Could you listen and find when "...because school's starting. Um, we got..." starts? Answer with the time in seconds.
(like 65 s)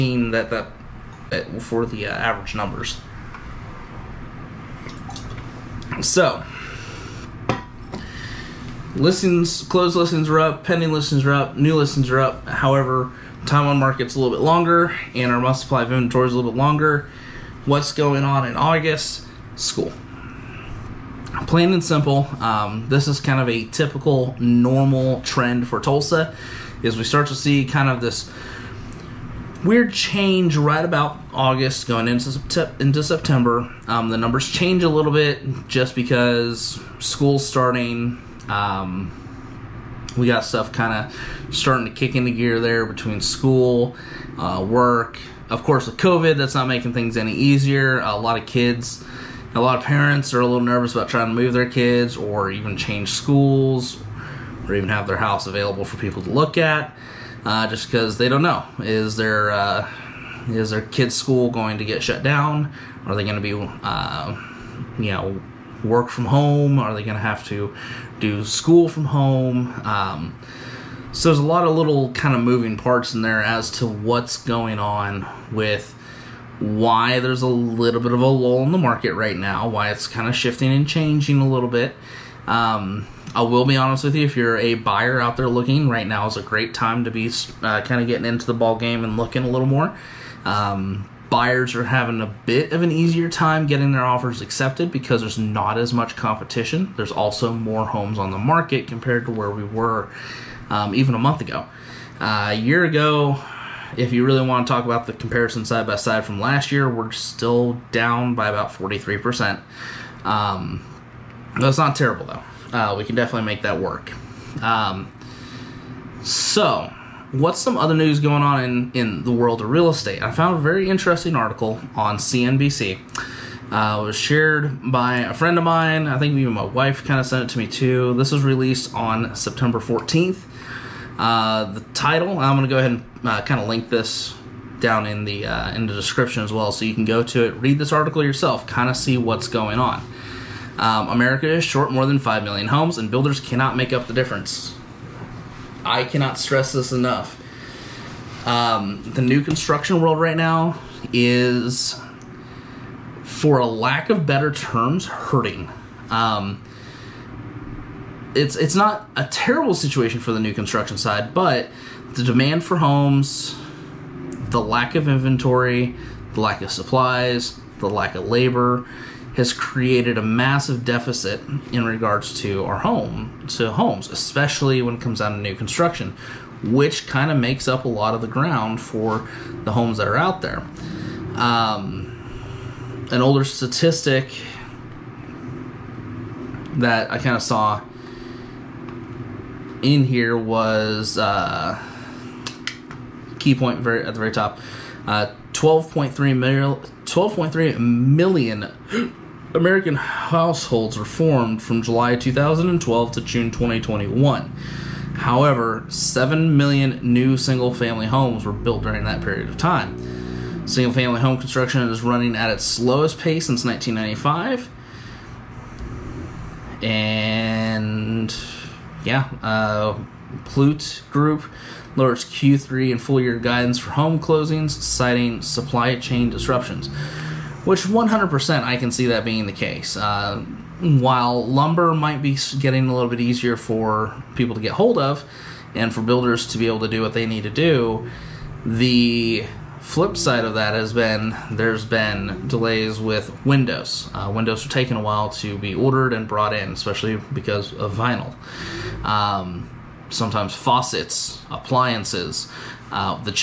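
35 s.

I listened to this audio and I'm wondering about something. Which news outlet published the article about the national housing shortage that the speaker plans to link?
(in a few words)
CNBC.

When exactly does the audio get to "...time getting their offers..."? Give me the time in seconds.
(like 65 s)
93 s.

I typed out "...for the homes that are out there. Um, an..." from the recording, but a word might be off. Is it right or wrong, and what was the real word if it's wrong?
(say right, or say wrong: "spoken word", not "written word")
right.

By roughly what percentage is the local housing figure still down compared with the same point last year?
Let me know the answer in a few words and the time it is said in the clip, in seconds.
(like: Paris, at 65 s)
43%, at 108 s.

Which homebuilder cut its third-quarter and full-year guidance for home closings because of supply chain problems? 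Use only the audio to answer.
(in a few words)
Pulte Group.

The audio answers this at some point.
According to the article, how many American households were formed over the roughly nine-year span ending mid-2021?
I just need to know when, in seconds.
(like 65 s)
195 s.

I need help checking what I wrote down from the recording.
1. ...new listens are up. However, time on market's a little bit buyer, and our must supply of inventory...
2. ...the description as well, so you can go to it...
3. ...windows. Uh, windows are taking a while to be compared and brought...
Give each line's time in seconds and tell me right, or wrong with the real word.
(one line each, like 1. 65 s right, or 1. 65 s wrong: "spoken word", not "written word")
1. 11 s wrong: "longer", not "buyer"
2. 135 s right
3. 243 s wrong: "ordered", not "compared".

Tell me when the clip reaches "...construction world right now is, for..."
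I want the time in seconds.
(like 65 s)
149 s.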